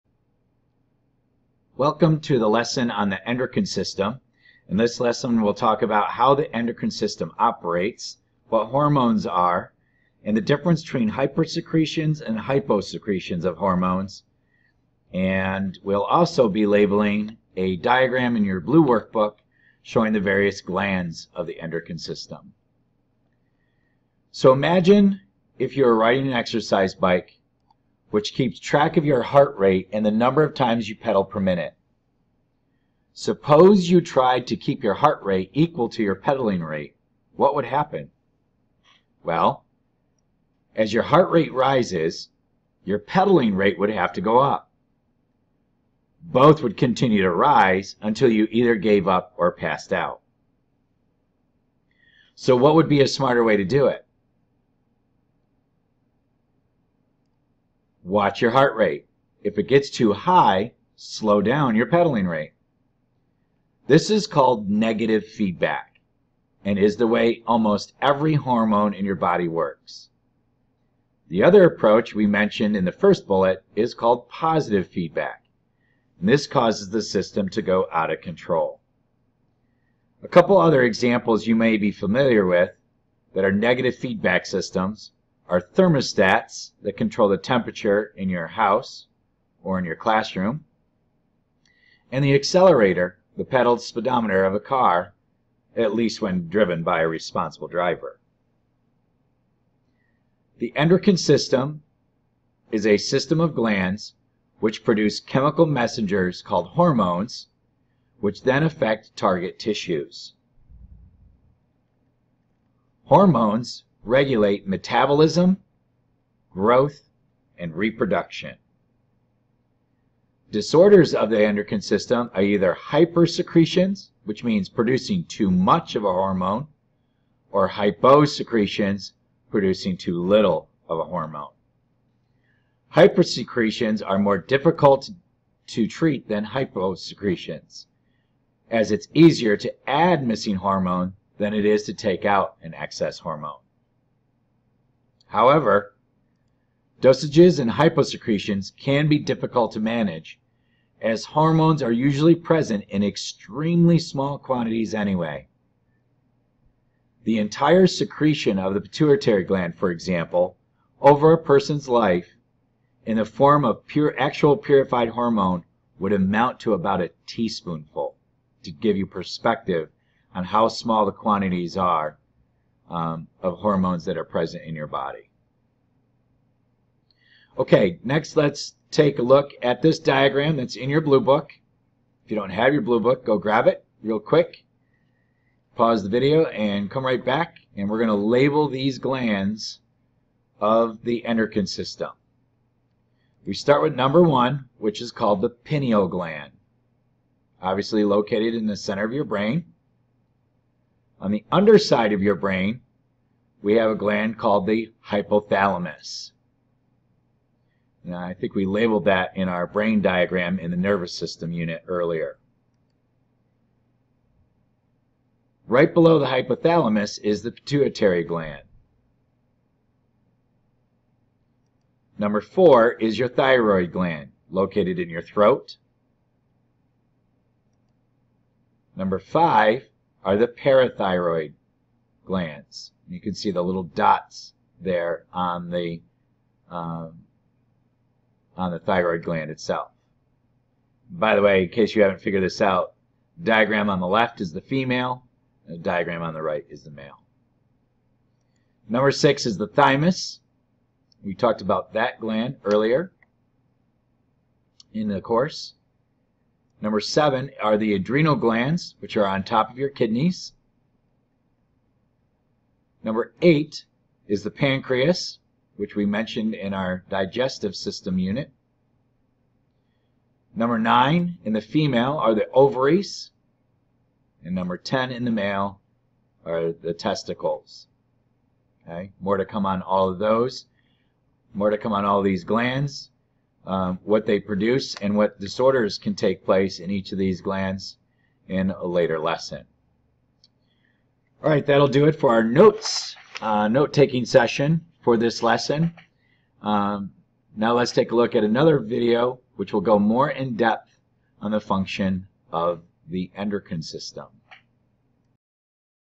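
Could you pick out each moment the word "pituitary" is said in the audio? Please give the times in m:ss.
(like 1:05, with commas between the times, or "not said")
2:38, 3:37.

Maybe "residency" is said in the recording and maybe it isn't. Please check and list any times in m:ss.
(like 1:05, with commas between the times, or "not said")
not said.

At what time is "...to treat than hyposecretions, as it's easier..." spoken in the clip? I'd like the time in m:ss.
2:15.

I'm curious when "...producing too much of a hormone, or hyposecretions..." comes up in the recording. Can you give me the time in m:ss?
2:04.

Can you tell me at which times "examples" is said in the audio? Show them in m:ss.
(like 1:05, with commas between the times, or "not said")
1:20, 2:39.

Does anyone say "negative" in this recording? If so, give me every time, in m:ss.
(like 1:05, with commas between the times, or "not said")
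1:04, 1:23.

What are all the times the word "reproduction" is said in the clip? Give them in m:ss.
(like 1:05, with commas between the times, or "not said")
1:57.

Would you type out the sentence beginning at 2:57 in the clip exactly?
Okay, next let's take a look at this diagram that's in your blue book.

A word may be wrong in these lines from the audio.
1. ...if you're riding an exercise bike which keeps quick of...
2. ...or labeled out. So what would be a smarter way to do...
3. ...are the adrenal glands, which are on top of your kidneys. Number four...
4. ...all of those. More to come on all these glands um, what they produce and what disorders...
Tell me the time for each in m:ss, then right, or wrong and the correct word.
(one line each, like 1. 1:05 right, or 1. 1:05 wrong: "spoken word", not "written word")
1. 0:25 wrong: "track", not "quick"
2. 0:49 wrong: "passed", not "labeled"
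3. 4:17 wrong: "eight", not "four"
4. 4:39 right.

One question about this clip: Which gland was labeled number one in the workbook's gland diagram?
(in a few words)
pineal gland.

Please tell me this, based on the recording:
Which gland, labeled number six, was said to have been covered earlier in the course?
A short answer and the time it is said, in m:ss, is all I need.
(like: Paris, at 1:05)
thymus, at 4:09.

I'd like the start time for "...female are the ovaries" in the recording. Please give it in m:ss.
4:31.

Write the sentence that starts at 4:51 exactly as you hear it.
All right, that'll do it for our notes, uh, note-taking session for this lesson.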